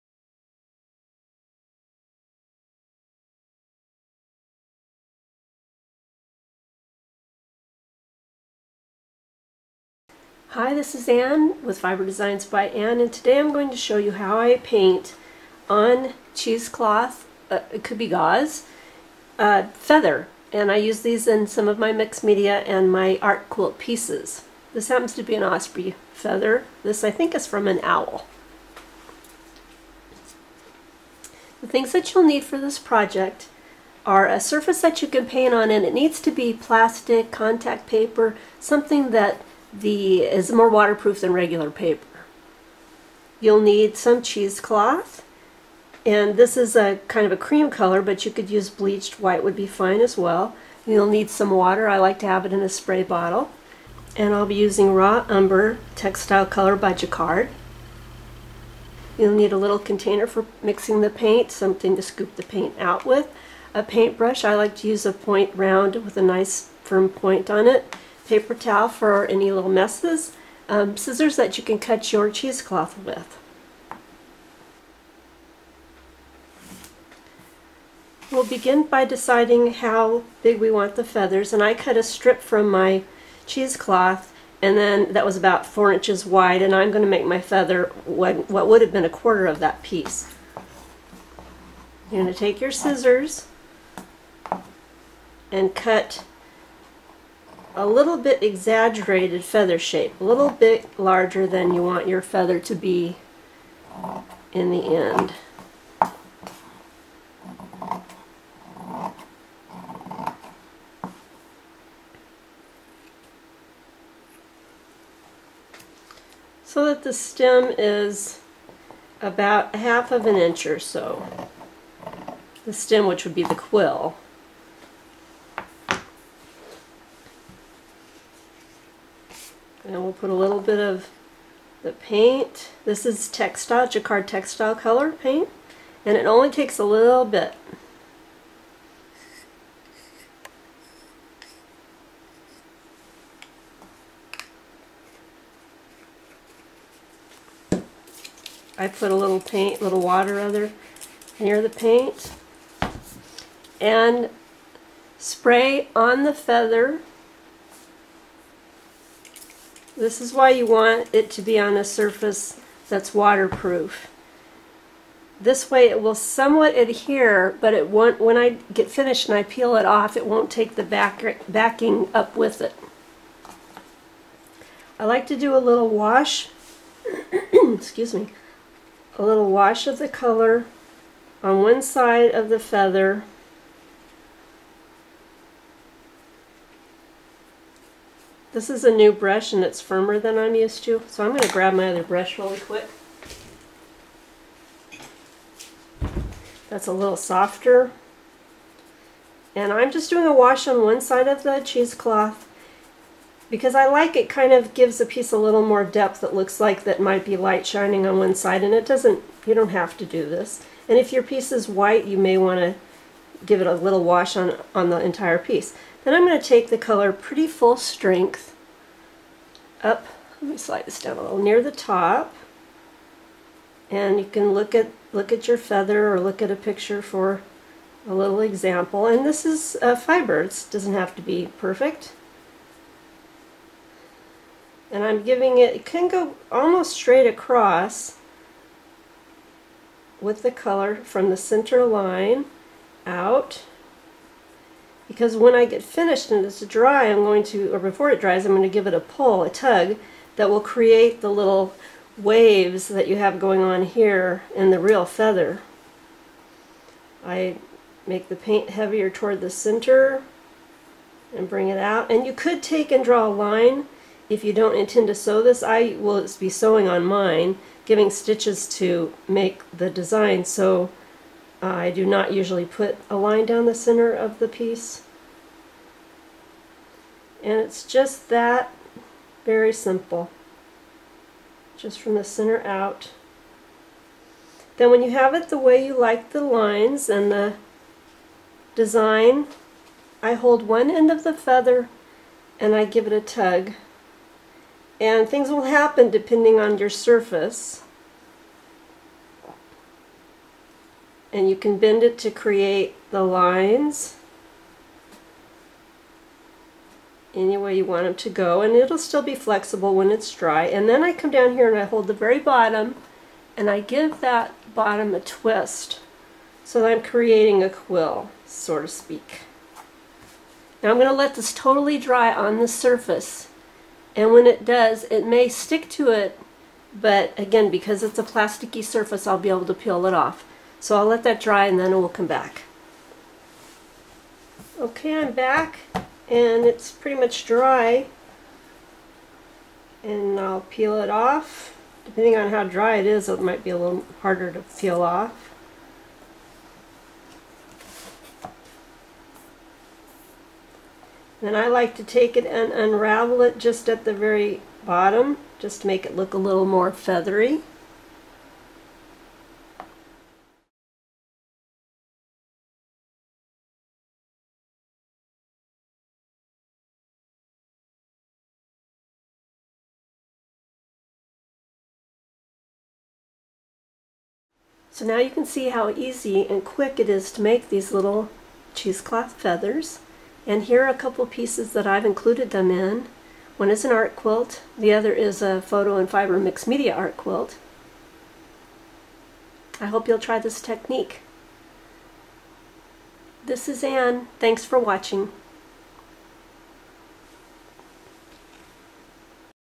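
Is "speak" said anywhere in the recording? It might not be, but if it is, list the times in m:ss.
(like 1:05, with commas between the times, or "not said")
5:18.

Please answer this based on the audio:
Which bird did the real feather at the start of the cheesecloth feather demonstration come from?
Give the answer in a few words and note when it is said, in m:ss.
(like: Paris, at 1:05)
Osprey, at 0:25.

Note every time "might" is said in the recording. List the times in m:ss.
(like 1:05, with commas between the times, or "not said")
3:27, 5:43.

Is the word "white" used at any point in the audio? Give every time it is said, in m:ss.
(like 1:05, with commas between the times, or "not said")
0:49, 3:31.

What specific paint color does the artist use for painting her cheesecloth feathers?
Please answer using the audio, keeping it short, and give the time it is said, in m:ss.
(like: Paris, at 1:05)
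Raw Umber, at 0:54.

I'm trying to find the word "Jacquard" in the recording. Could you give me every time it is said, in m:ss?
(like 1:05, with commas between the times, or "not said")
0:56, 2:13.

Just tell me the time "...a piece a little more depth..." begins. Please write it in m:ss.
3:24.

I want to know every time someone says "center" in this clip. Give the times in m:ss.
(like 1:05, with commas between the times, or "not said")
4:01, 4:19, 4:33, 4:42.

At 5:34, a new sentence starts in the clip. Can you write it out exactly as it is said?
Okay, I'm back and it's pretty much dry.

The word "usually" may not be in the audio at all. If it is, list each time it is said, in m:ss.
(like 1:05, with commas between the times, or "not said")
4:32.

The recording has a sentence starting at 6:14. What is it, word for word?
So now you can see how easy and quick it is to make these little cheesecloth feathers.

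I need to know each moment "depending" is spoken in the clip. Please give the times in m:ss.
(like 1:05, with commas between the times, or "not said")
4:56, 5:42.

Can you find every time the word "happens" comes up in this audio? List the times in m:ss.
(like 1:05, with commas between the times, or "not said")
0:24, 4:55.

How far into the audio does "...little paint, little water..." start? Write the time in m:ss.
2:29.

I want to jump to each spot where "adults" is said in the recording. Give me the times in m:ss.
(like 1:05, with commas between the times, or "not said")
not said.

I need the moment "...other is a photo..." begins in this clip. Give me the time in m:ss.
6:24.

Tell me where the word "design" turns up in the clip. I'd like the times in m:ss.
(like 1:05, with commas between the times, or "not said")
0:12, 4:29, 4:48.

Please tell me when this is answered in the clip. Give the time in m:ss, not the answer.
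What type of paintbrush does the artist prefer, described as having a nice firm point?
1:05.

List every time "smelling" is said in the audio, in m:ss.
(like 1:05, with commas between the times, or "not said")
not said.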